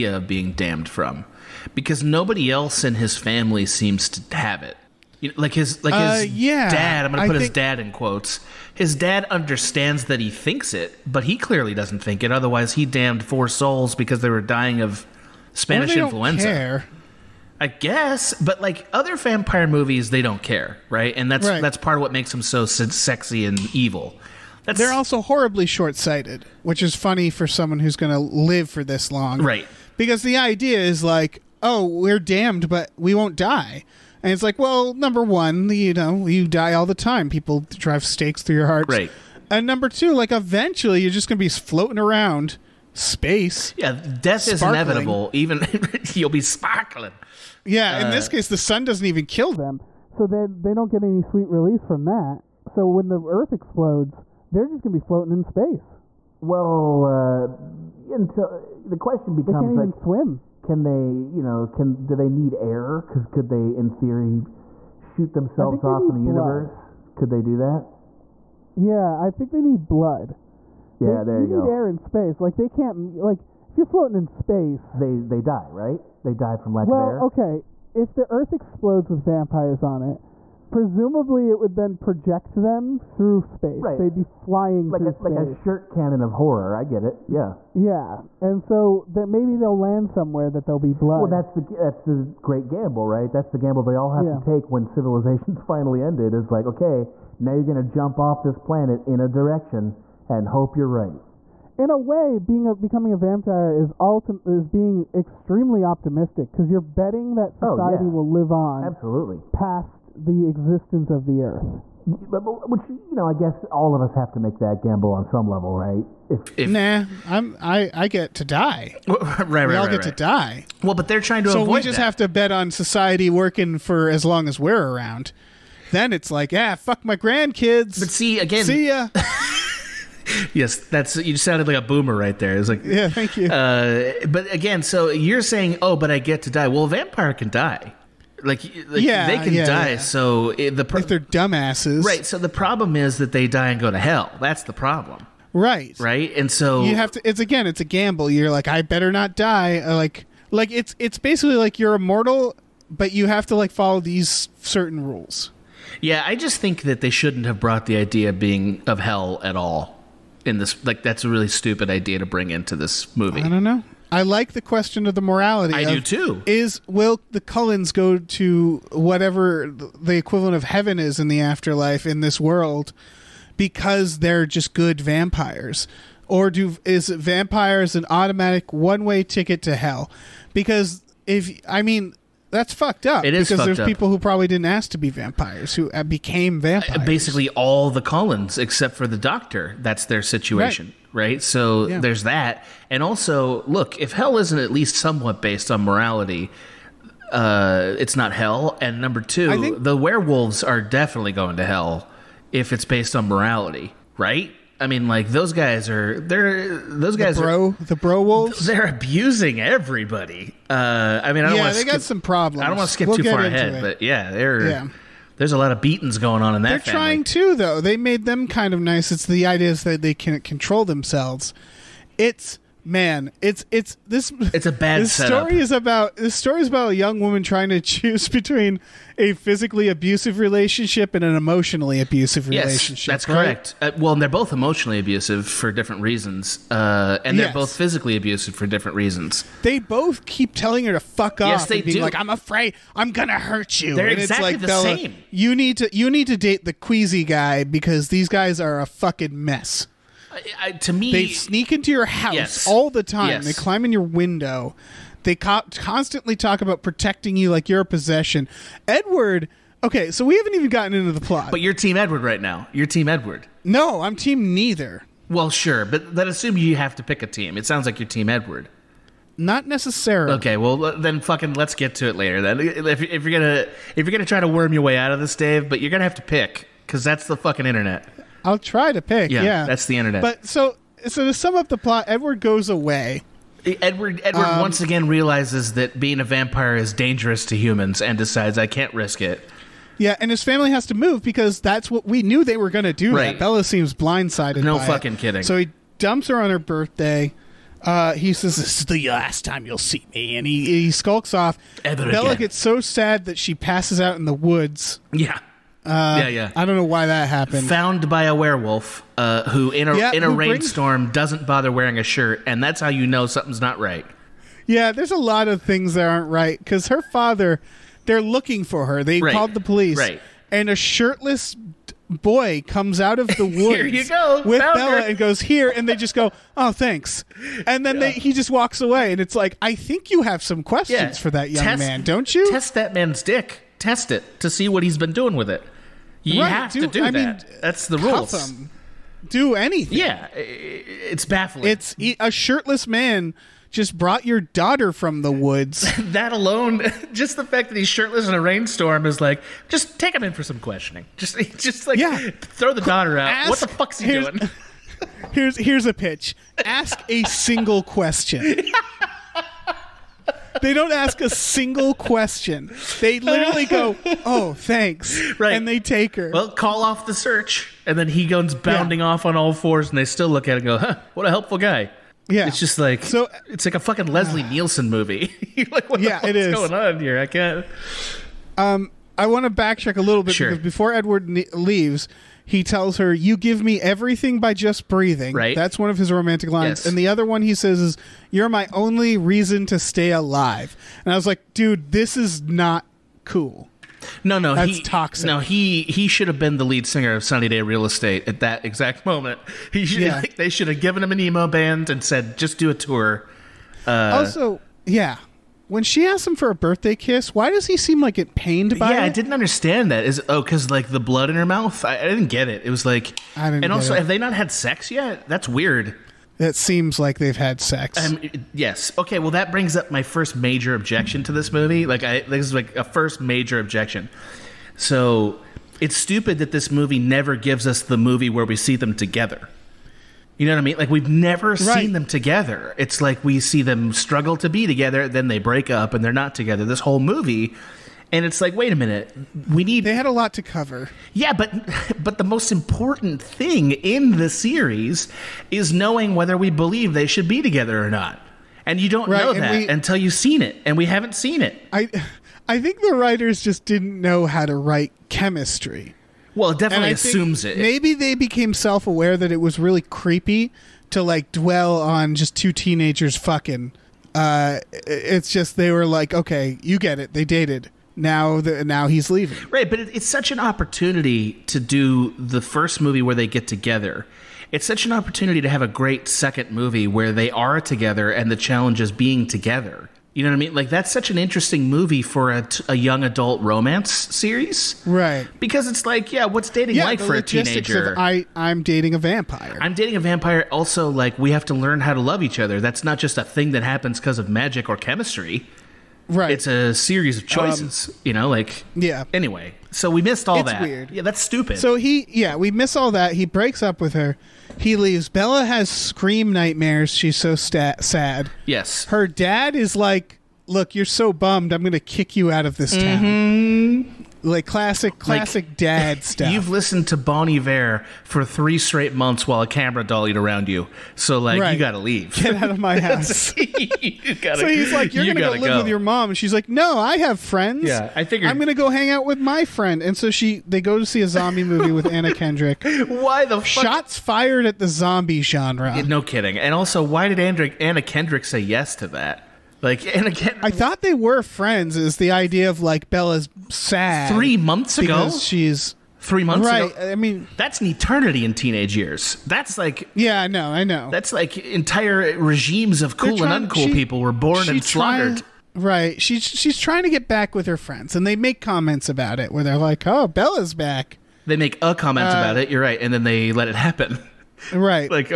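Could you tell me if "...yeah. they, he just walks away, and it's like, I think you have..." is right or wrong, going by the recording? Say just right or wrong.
right.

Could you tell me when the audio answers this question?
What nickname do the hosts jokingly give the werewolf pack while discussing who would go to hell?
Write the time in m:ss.
3:27.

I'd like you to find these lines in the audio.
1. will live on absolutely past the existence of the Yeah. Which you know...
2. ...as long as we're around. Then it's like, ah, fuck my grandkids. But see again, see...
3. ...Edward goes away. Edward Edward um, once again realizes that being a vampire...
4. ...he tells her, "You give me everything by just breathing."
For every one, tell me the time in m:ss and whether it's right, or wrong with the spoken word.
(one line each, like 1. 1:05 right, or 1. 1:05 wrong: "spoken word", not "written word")
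1. 1:48 wrong: "Earth", not "Yeah"
2. 2:04 right
3. 4:42 right
4. 6:22 right.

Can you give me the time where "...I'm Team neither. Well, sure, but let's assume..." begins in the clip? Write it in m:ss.
4:24.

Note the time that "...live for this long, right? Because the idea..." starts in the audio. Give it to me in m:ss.
0:28.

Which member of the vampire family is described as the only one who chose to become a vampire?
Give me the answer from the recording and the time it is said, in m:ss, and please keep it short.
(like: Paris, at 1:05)
the Doctor, at 3:09.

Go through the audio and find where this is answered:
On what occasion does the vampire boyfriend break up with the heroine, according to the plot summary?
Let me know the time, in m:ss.
4:56.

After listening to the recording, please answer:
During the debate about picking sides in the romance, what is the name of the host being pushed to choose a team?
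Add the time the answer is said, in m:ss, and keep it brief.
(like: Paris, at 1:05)
Dave, at 4:35.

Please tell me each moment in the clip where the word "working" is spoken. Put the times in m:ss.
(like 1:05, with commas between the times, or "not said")
2:03.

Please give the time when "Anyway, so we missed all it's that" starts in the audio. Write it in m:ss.
8:19.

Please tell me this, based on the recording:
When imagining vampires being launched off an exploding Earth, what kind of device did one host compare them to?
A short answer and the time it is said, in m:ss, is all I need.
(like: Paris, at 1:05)
shirt cannon, at 1:25.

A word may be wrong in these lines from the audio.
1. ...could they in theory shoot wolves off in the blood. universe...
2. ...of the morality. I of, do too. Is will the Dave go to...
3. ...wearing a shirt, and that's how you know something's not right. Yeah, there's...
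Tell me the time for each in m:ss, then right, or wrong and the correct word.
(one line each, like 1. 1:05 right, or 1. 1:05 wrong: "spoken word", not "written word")
1. 1:03 wrong: "themselves", not "wolves"
2. 2:45 wrong: "Cullens", not "Dave"
3. 5:11 right.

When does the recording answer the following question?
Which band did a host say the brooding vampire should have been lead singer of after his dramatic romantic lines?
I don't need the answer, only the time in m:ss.
6:37.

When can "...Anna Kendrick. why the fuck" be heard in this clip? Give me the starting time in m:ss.
8:51.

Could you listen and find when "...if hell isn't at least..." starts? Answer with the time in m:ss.
3:13.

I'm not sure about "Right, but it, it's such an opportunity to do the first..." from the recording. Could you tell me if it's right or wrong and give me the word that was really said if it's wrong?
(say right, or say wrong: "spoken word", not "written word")
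right.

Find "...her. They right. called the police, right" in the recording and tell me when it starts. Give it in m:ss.
5:18.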